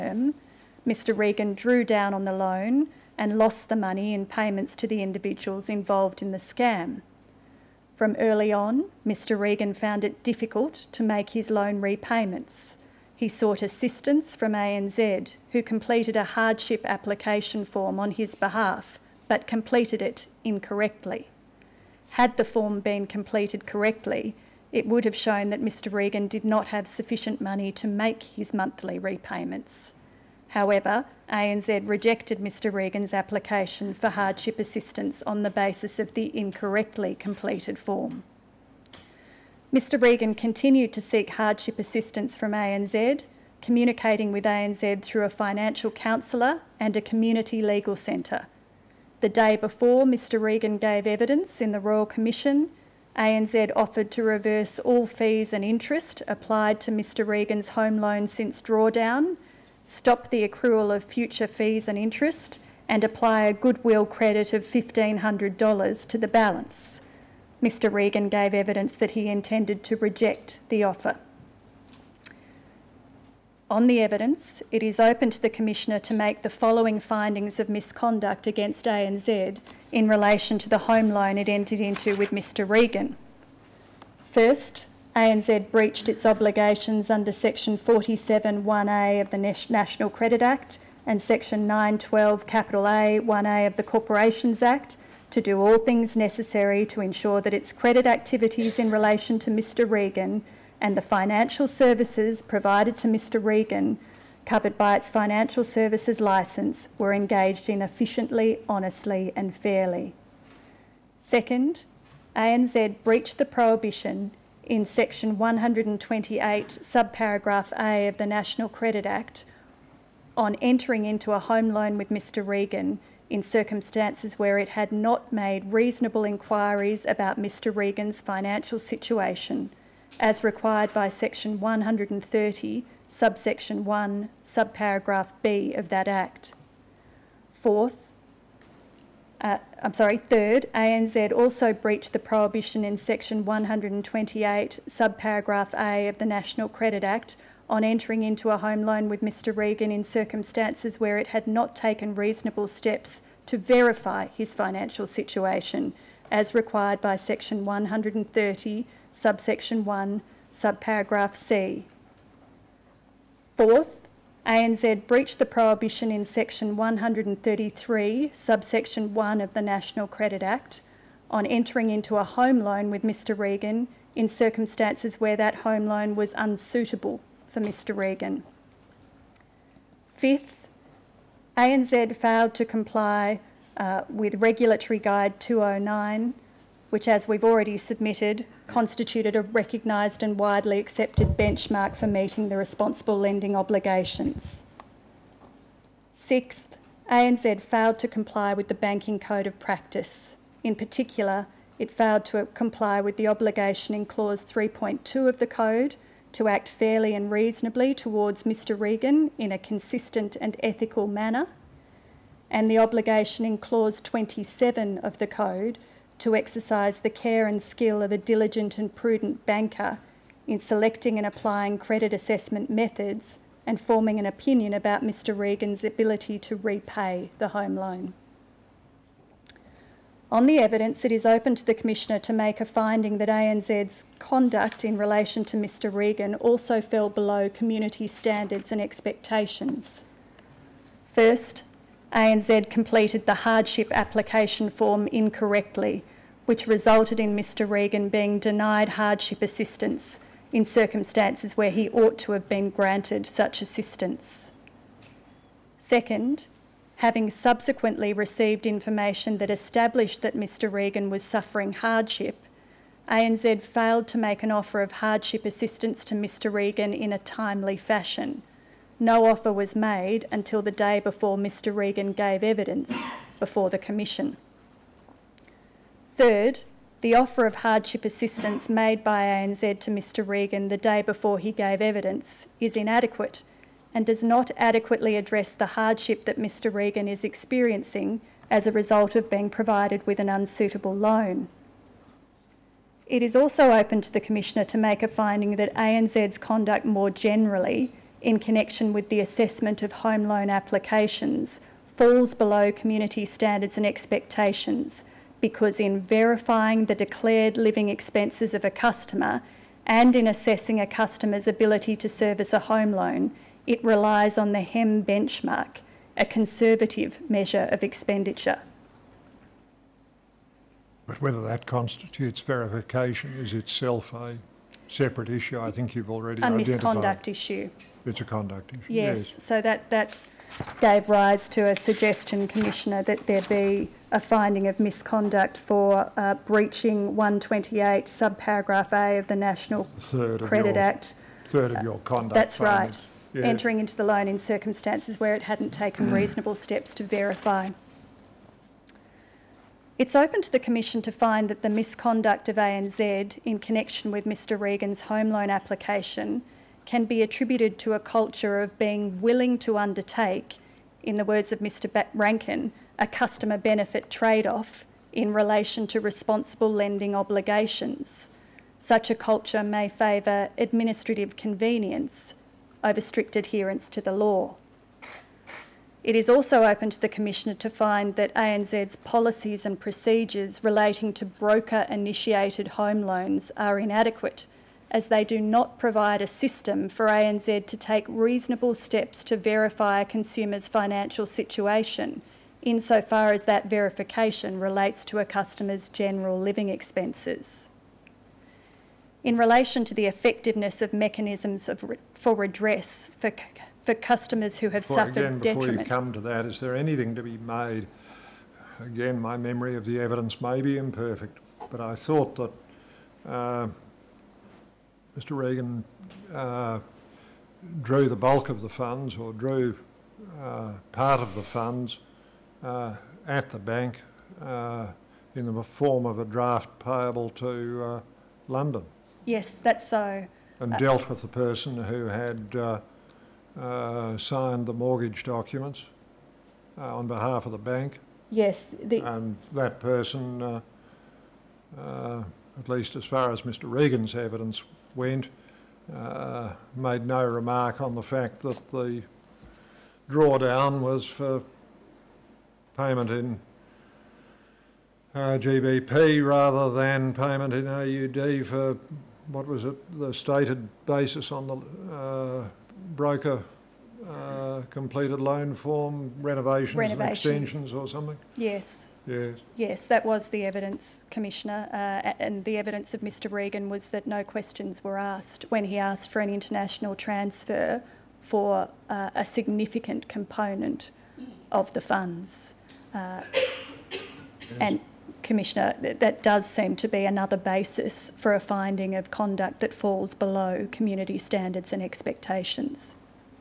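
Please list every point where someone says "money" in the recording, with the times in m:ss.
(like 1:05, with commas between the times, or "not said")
0:03, 0:27.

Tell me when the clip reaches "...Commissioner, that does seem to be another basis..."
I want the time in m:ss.
8:05.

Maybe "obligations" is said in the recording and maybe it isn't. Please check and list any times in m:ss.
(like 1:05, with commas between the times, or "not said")
1:26, 3:13, 3:23, 3:32, 6:07.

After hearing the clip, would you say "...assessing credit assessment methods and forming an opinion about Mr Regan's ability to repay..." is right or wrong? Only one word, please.
wrong.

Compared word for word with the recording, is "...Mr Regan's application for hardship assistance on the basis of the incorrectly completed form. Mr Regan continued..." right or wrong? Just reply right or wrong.
right.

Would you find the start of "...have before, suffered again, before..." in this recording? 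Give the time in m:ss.
6:44.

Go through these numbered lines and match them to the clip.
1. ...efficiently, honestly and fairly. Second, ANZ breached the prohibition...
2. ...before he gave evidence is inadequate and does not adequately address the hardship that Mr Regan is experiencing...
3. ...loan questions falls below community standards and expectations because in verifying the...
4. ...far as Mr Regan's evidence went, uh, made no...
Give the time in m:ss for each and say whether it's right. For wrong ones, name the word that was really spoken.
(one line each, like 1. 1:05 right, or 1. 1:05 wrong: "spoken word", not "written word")
1. 1:47 right
2. 4:41 right
3. 5:00 wrong: "applications", not "questions"
4. 7:23 right.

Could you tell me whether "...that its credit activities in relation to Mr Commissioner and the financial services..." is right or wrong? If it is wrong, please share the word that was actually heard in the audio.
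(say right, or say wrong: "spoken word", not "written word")
wrong: "Regan", not "Commissioner".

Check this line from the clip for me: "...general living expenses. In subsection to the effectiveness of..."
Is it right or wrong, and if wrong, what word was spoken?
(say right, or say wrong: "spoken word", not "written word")
wrong: "relation", not "subsection".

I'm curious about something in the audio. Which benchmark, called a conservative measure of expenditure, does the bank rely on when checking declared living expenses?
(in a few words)
HEM benchmark.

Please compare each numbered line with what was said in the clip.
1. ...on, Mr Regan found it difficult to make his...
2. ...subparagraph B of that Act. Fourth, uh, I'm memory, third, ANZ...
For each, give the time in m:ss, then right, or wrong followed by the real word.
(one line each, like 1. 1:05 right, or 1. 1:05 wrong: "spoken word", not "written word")
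1. 0:08 right
2. 2:14 wrong: "sorry", not "memory".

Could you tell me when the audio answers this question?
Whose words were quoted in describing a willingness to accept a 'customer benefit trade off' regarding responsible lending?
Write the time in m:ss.
6:01.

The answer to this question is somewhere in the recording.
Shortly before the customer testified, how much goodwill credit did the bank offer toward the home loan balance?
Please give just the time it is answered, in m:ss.
1:04.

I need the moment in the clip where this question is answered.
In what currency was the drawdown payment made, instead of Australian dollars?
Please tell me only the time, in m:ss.
7:35.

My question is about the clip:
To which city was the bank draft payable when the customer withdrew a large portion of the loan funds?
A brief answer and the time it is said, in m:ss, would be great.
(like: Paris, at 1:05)
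London, at 7:08.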